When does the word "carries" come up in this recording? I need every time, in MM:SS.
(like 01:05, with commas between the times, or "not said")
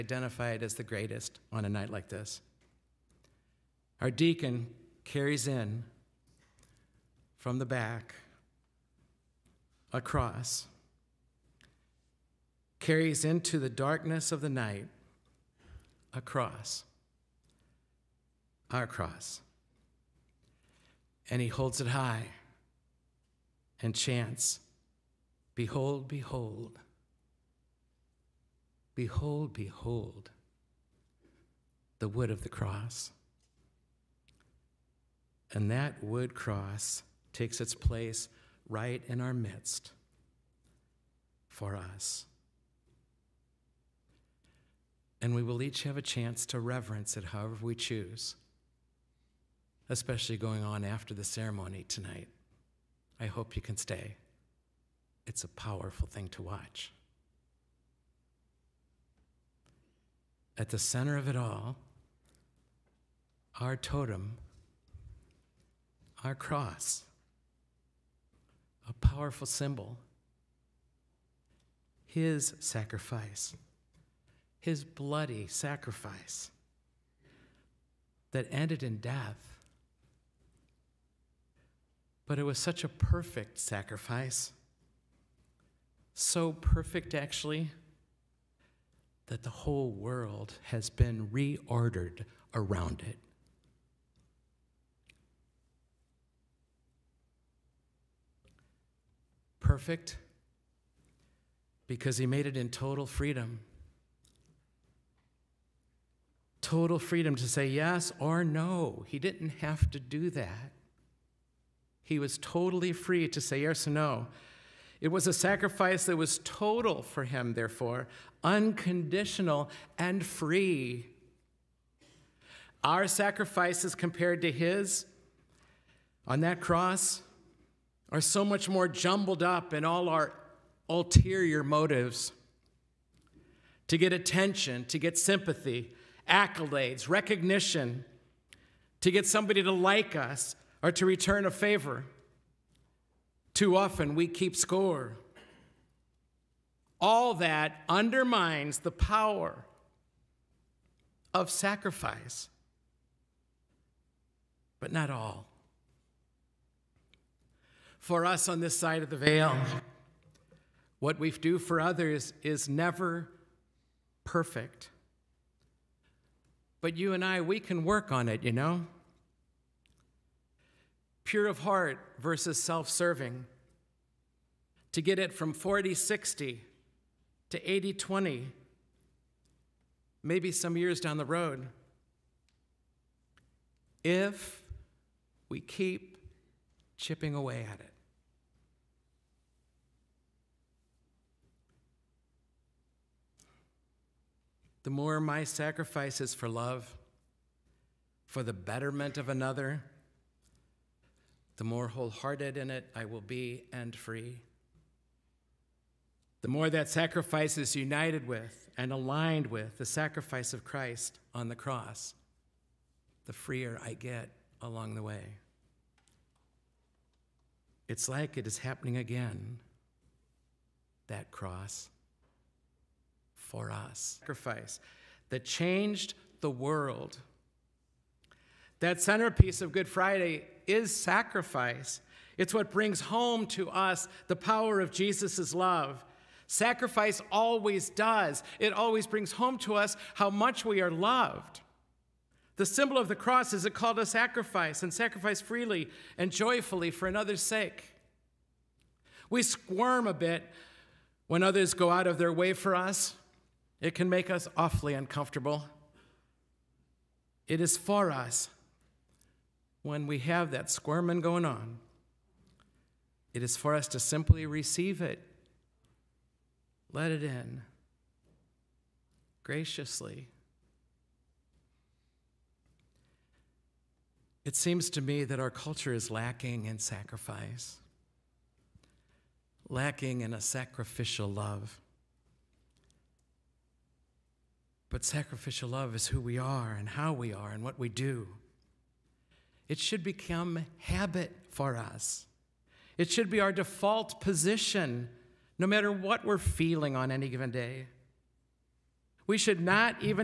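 00:05, 00:12.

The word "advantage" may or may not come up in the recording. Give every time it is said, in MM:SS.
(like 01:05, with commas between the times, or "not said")
not said.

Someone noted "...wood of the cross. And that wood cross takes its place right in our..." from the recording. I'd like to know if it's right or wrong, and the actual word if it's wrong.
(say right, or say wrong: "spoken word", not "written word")
right.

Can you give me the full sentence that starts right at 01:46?
Total freedom to say yes or no.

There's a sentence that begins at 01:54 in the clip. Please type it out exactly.
It was a sacrifice that was total for him, therefore, unconditional and free.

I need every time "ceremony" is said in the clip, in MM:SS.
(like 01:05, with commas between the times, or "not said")
00:51.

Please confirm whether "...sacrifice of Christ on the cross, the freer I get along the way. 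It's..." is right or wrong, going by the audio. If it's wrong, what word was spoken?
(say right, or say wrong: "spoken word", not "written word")
right.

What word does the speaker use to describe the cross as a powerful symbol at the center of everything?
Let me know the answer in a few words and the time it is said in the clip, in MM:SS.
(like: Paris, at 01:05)
totem, at 01:03.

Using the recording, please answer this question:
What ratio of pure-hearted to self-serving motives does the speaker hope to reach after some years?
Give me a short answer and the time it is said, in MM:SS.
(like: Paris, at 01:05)
80 20, at 02:57.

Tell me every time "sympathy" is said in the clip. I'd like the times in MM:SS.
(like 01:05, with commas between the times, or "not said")
02:15.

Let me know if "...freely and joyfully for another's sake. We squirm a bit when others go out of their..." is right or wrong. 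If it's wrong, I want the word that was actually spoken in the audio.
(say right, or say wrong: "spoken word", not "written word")
right.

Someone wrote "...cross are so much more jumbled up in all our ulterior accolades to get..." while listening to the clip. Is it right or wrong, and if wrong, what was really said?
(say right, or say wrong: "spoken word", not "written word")
wrong: "motives", not "accolades".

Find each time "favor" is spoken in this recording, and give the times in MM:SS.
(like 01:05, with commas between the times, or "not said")
02:21.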